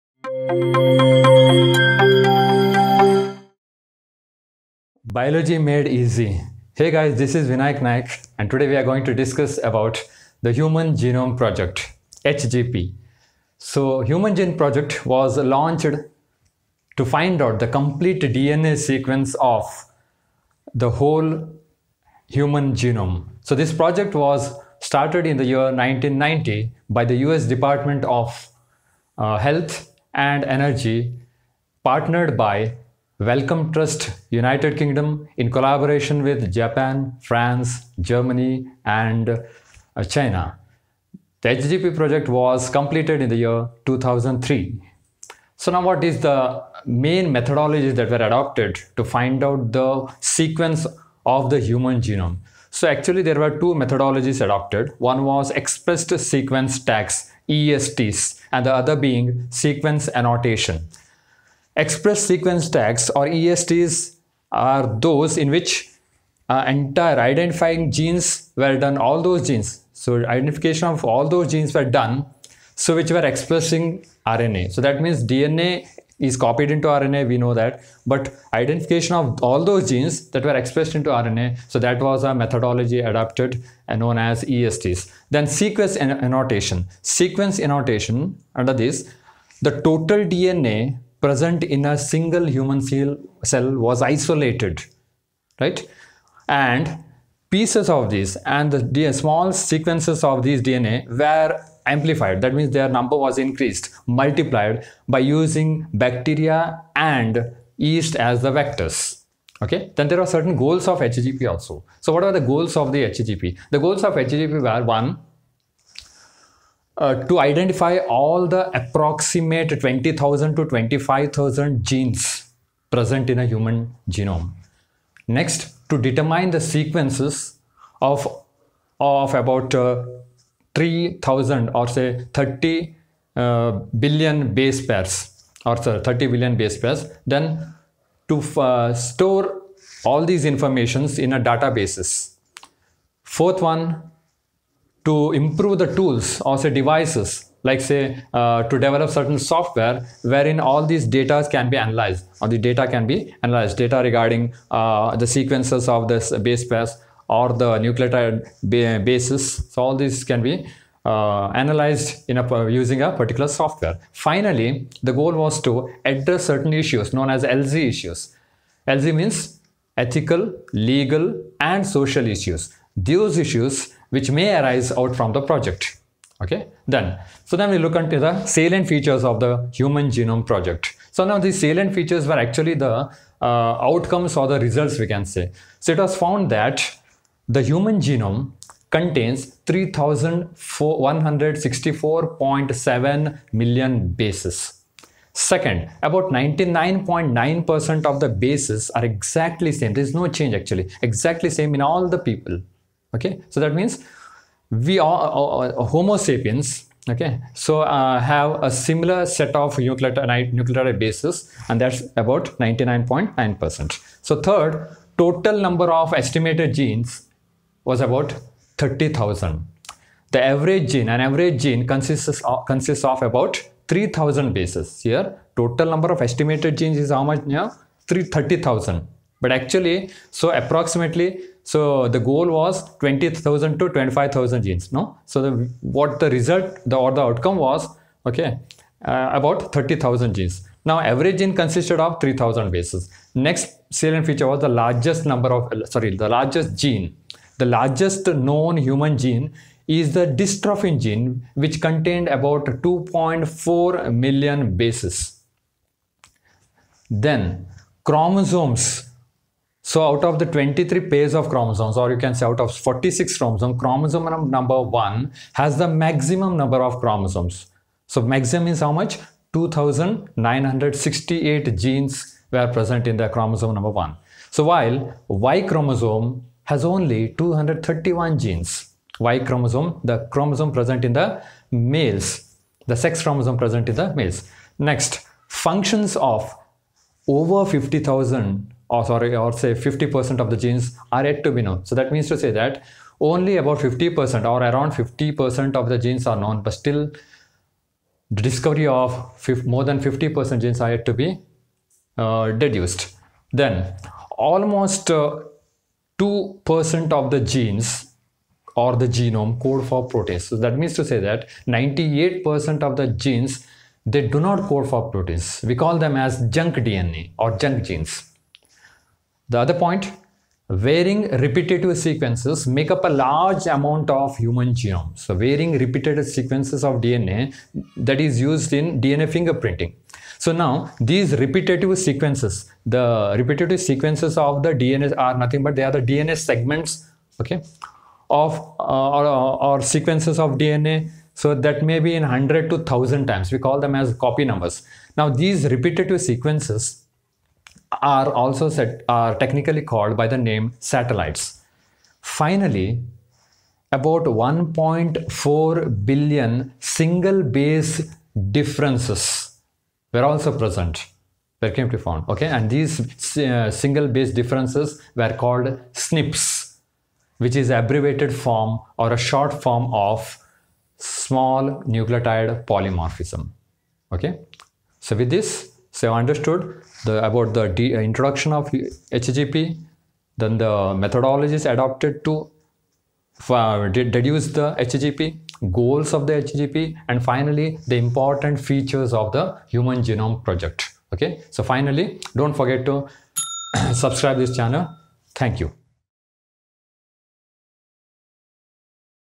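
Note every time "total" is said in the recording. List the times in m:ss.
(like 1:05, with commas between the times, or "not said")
1:29, 3:35, 3:45.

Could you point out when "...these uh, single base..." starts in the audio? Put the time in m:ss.
6:02.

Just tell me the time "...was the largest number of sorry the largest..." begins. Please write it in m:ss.
4:04.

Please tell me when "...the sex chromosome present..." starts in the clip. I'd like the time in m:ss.
4:42.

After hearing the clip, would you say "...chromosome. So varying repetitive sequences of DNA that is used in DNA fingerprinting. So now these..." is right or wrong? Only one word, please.
wrong.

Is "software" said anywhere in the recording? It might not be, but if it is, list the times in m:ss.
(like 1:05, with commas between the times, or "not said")
2:29, 2:43.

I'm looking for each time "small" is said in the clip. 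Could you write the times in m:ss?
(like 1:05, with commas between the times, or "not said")
1:39, 6:10.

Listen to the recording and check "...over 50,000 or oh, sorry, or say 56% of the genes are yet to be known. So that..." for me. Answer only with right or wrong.
wrong.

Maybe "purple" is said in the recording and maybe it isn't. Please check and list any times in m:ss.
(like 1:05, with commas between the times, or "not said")
not said.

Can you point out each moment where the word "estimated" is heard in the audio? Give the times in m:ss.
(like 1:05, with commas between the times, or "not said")
3:36, 3:46.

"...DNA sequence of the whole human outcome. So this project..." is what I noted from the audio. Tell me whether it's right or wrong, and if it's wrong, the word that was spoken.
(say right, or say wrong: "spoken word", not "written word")
wrong: "genome", not "outcome".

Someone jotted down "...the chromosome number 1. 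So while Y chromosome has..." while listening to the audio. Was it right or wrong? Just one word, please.
right.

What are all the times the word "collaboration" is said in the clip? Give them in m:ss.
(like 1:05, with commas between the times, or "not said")
0:35.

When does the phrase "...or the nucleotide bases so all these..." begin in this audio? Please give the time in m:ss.
2:37.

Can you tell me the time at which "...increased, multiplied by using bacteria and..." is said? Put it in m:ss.
1:43.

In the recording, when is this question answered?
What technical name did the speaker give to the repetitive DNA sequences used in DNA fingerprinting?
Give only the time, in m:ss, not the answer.
5:50.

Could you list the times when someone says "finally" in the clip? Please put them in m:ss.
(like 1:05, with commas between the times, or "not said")
2:44, 5:52, 6:27, 6:31.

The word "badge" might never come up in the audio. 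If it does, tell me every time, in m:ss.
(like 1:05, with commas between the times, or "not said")
not said.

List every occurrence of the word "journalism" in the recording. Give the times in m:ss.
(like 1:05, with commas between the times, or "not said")
not said.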